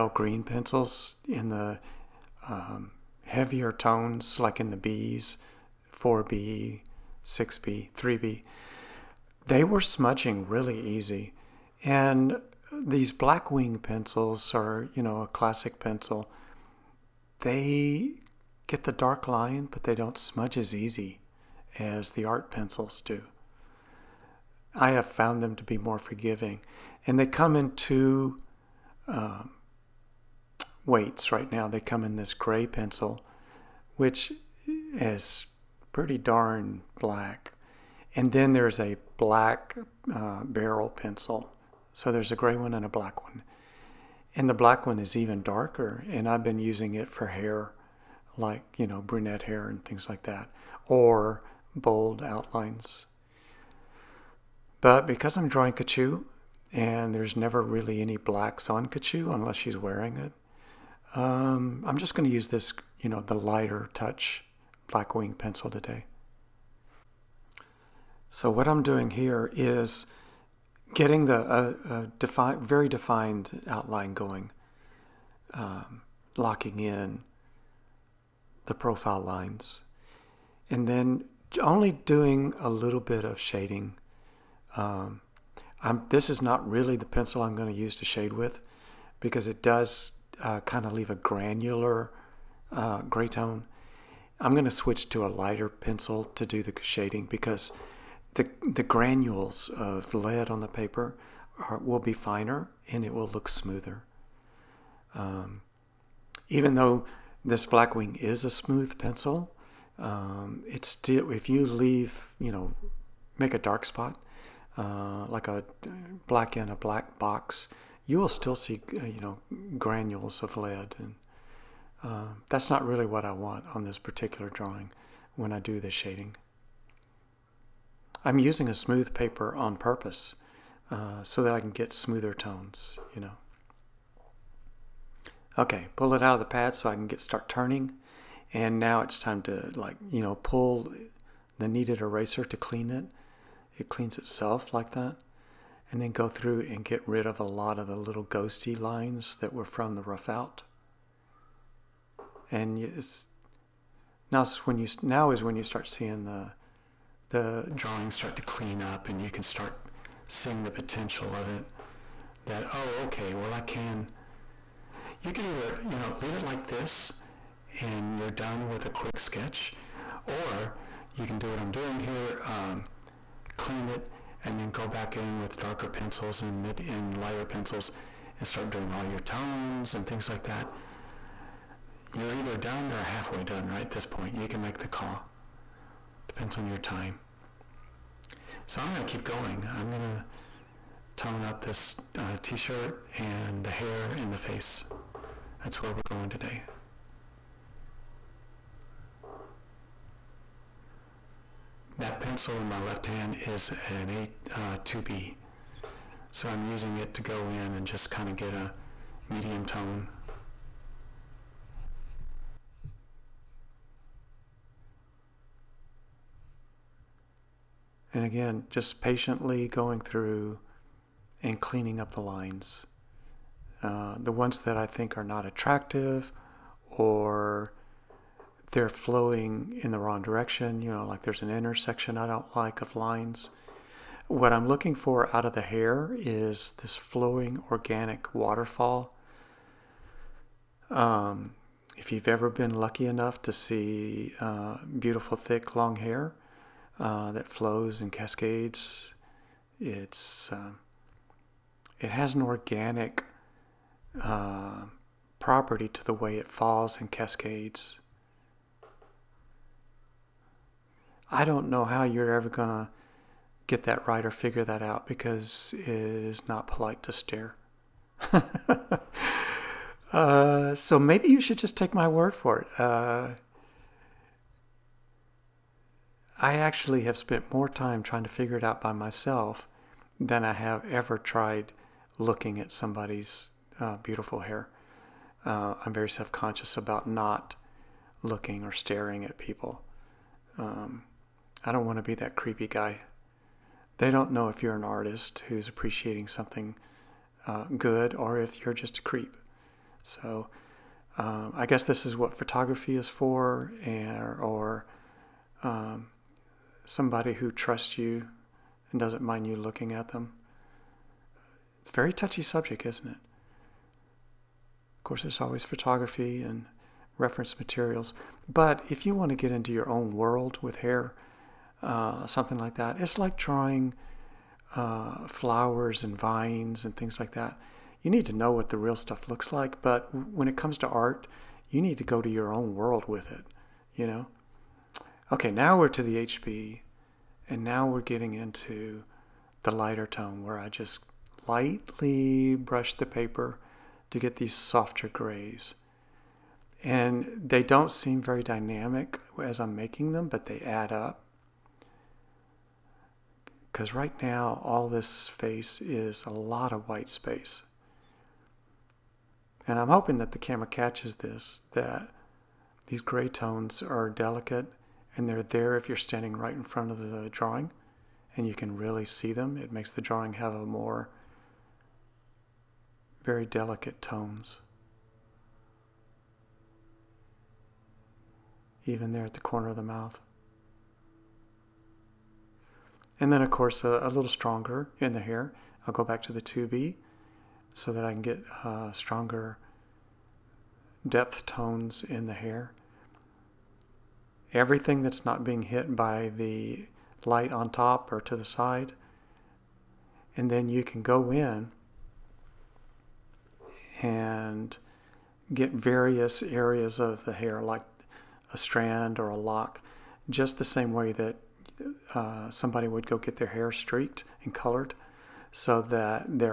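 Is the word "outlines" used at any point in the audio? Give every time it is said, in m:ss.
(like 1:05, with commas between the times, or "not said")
0:52, 1:13.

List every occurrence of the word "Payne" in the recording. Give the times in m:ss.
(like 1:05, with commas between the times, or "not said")
not said.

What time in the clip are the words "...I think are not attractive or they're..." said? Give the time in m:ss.
3:44.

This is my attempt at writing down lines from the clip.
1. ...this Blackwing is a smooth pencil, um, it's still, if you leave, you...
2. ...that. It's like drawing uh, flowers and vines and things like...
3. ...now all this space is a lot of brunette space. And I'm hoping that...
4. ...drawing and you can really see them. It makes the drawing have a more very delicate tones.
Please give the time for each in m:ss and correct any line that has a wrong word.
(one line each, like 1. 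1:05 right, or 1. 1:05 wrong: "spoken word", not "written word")
1. 1:47 right
2. 5:22 right
3. 5:54 wrong: "white", not "brunette"
4. 6:07 right.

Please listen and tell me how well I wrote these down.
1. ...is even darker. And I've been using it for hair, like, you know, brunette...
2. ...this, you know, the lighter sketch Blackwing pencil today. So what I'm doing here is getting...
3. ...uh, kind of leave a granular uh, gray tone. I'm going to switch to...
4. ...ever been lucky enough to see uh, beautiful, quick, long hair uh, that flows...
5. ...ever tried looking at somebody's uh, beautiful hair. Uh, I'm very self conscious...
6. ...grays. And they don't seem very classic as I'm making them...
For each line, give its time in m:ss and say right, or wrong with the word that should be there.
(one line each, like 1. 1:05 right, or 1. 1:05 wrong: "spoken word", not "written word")
1. 0:44 right
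2. 1:02 wrong: "touch", not "sketch"
3. 1:30 right
4. 4:02 wrong: "thick", not "quick"
5. 4:40 right
6. 5:45 wrong: "dynamic", not "classic".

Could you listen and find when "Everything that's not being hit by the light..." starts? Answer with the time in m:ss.
6:34.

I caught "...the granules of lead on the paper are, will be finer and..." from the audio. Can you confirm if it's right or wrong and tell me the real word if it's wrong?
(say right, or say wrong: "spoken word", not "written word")
right.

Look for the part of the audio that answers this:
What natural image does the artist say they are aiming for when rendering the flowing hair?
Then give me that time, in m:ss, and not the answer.
3:57.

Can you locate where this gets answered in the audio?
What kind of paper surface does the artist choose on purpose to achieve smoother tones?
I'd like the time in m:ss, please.
2:08.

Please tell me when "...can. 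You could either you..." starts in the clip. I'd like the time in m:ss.
2:43.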